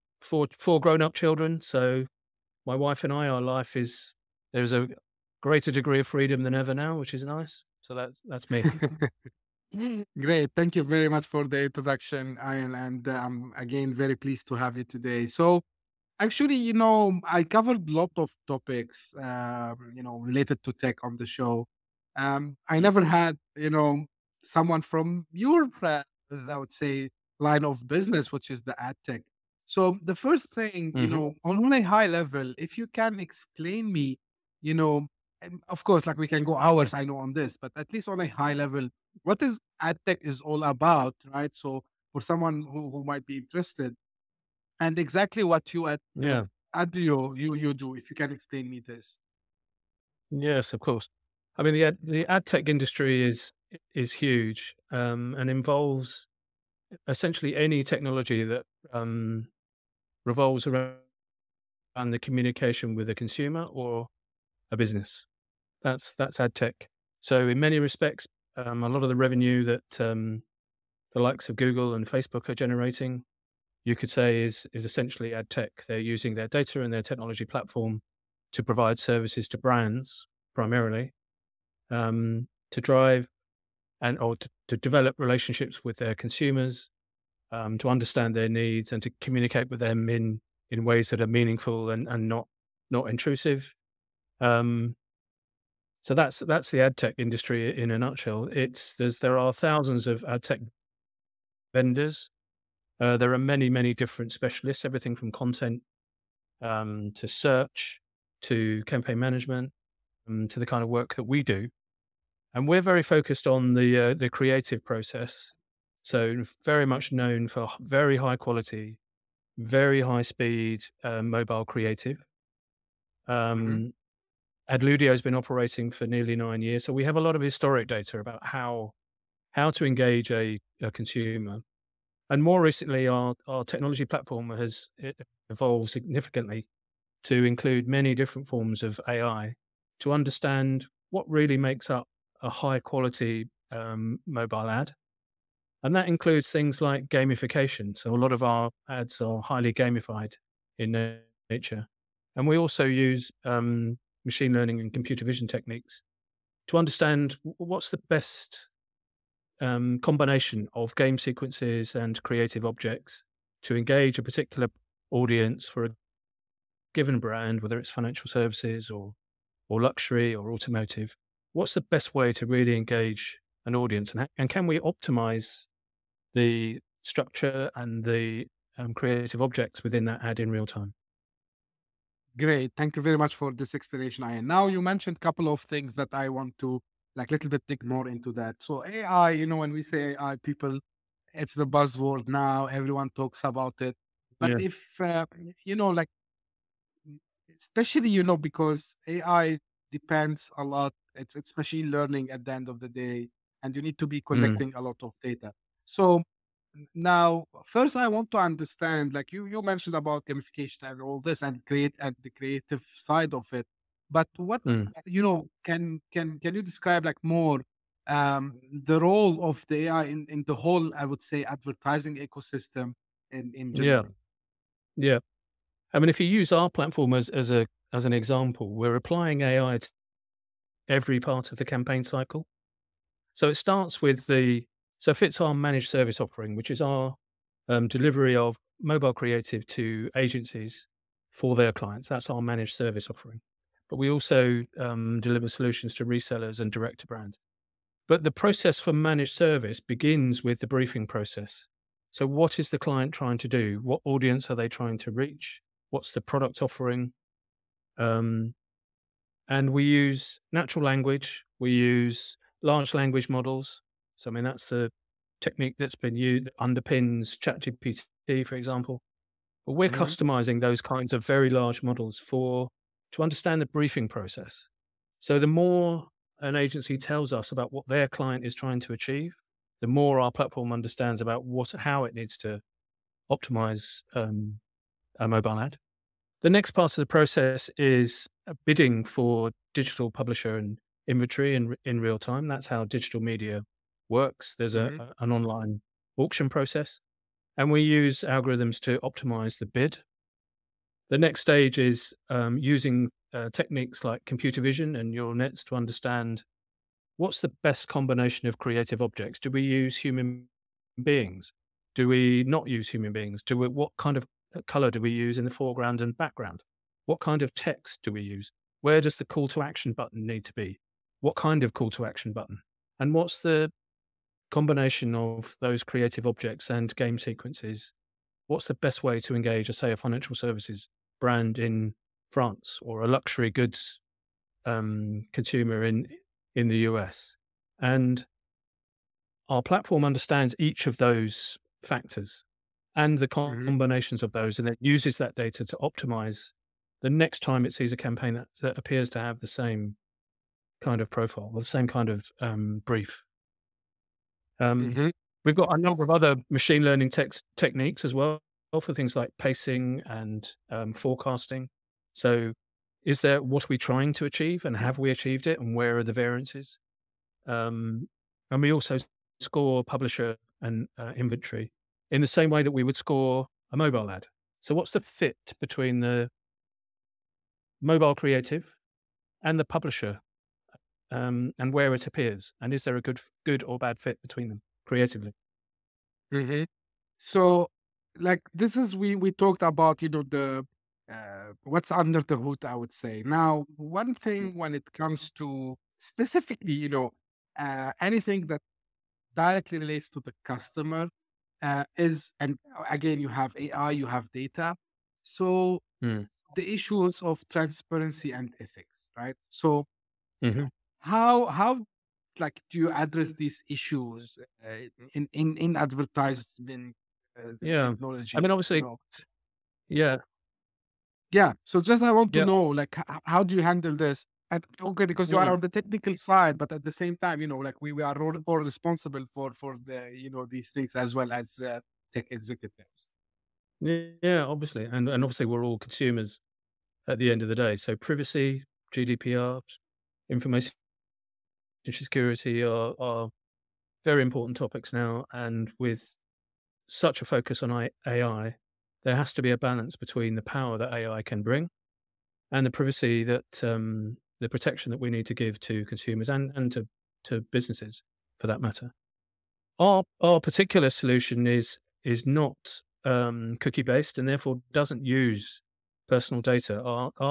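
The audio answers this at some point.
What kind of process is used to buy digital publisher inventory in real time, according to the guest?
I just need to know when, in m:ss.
4:55.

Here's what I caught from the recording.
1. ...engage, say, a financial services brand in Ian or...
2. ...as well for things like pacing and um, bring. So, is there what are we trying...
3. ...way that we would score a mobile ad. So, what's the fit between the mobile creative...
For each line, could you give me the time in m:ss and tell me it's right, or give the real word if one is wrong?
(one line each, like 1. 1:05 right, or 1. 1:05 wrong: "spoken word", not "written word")
1. 5:29 wrong: "France", not "Ian"
2. 5:58 wrong: "forecasting", not "bring"
3. 6:12 right.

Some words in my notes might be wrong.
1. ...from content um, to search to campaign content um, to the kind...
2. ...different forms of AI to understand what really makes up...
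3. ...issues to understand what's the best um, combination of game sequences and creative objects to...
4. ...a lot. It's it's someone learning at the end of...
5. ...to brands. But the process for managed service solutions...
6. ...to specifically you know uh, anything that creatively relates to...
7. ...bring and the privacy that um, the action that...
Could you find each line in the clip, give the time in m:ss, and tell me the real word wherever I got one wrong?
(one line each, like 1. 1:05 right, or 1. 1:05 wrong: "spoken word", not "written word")
1. 1:45 wrong: "management", not "content"
2. 2:18 right
3. 2:35 wrong: "techniques", not "issues"
4. 3:20 wrong: "machine", not "someone"
5. 4:06 wrong: "begins", not "solutions"
6. 6:35 wrong: "directly", not "creatively"
7. 7:31 wrong: "protection", not "action".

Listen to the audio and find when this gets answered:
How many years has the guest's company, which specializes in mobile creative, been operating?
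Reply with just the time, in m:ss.
2:06.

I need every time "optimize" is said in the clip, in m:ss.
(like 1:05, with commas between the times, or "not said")
2:54, 4:43, 4:58, 5:45.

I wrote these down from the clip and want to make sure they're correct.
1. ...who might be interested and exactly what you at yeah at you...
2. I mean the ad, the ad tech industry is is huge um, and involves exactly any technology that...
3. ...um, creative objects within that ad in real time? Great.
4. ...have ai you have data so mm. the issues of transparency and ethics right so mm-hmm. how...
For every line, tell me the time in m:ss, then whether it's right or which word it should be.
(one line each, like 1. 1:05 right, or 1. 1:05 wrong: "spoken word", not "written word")
1. 0:42 right
2. 0:51 wrong: "essentially", not "exactly"
3. 2:58 right
4. 6:43 right.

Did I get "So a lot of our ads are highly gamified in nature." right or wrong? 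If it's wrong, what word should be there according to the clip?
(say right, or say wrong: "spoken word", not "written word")
right.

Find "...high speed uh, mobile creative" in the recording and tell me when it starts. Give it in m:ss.
2:00.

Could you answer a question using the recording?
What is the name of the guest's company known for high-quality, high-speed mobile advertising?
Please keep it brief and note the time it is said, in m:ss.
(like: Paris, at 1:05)
Adludio, at 2:04.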